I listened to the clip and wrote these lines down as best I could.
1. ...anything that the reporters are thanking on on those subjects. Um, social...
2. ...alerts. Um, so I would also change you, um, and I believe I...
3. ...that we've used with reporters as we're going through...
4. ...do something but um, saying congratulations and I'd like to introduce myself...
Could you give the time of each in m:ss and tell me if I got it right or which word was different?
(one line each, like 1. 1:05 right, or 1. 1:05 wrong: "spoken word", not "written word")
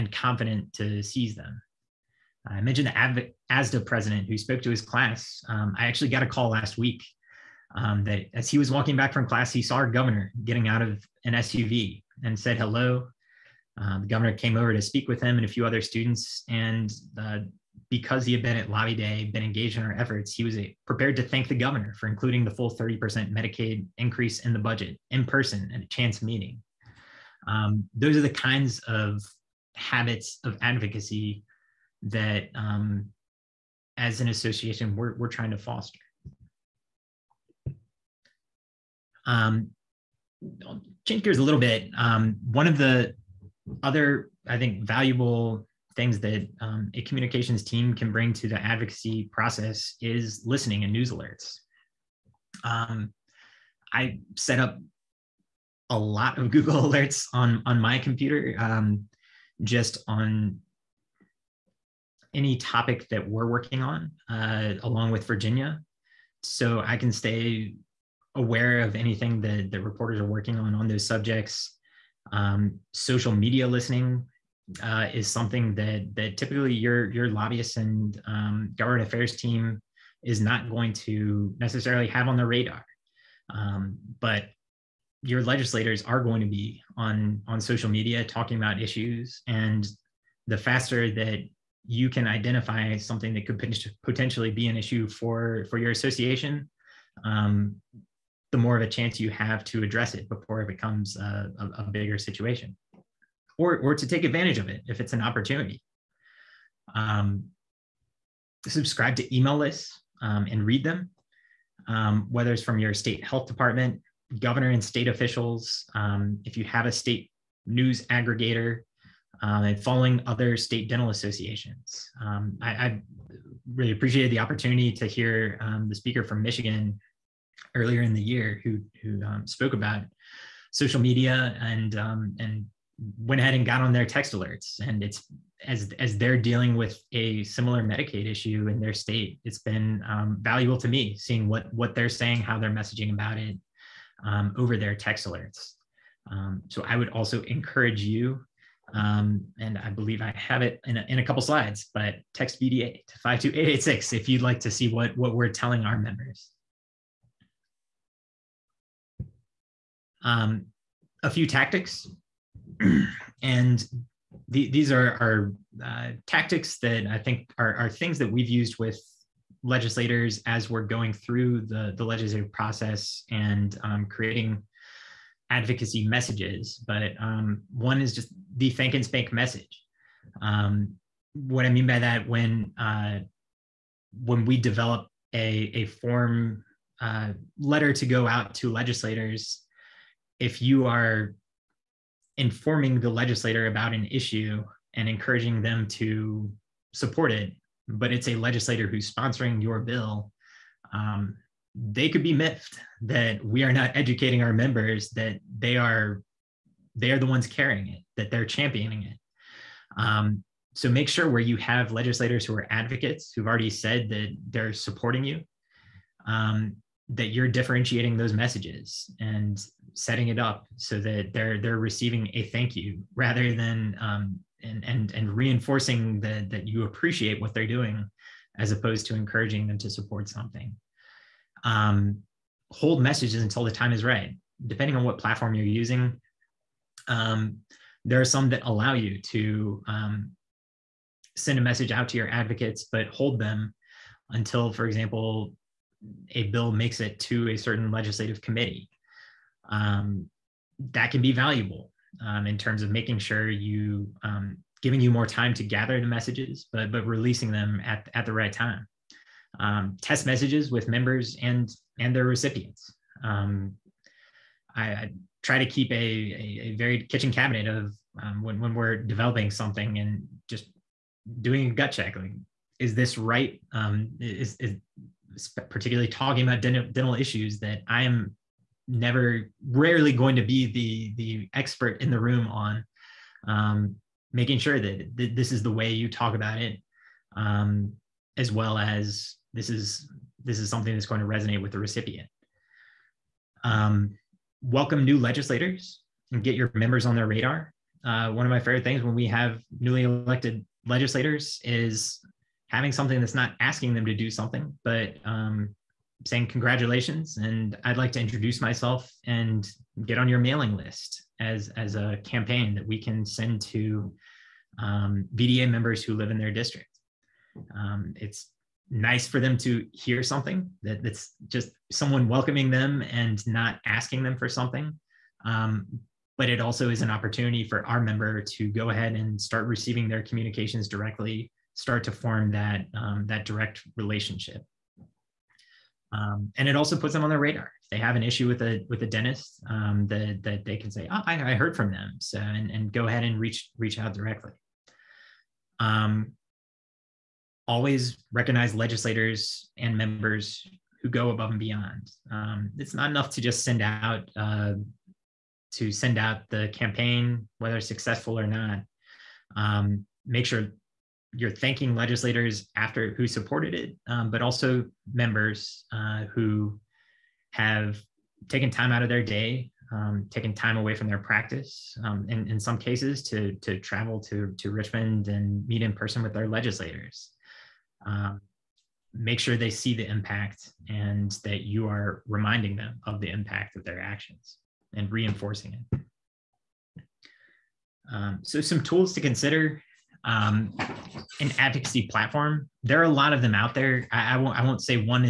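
1. 1:08 wrong: "working", not "thanking"
2. 2:25 wrong: "encourage", not "change"
3. 2:48 wrong: "legislators", not "reporters"
4. 5:04 right.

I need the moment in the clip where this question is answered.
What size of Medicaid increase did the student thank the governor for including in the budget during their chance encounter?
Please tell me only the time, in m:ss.
0:22.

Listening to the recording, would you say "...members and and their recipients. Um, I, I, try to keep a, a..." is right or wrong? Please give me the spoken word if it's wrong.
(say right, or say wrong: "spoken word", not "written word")
right.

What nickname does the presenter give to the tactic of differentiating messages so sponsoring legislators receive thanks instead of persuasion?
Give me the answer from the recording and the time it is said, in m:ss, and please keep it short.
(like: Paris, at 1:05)
thank and spank, at 2:58.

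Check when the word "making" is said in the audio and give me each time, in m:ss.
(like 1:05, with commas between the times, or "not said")
4:12, 4:44.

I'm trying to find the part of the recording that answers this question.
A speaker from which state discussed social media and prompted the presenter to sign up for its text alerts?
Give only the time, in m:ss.
2:06.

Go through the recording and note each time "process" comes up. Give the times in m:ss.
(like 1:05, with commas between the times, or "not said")
0:49, 2:52.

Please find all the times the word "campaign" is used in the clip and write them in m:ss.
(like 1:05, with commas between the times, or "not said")
5:12, 5:56.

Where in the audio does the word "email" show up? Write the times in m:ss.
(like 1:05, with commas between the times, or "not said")
1:49.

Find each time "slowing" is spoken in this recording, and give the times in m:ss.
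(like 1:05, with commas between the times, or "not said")
not said.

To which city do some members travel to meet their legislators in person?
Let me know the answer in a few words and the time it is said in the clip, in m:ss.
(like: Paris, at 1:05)
Richmond, at 6:14.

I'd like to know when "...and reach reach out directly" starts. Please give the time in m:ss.
5:43.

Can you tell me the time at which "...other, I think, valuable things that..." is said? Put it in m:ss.
0:43.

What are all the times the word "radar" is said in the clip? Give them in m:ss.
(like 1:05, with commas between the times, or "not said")
1:22, 4:57, 5:37.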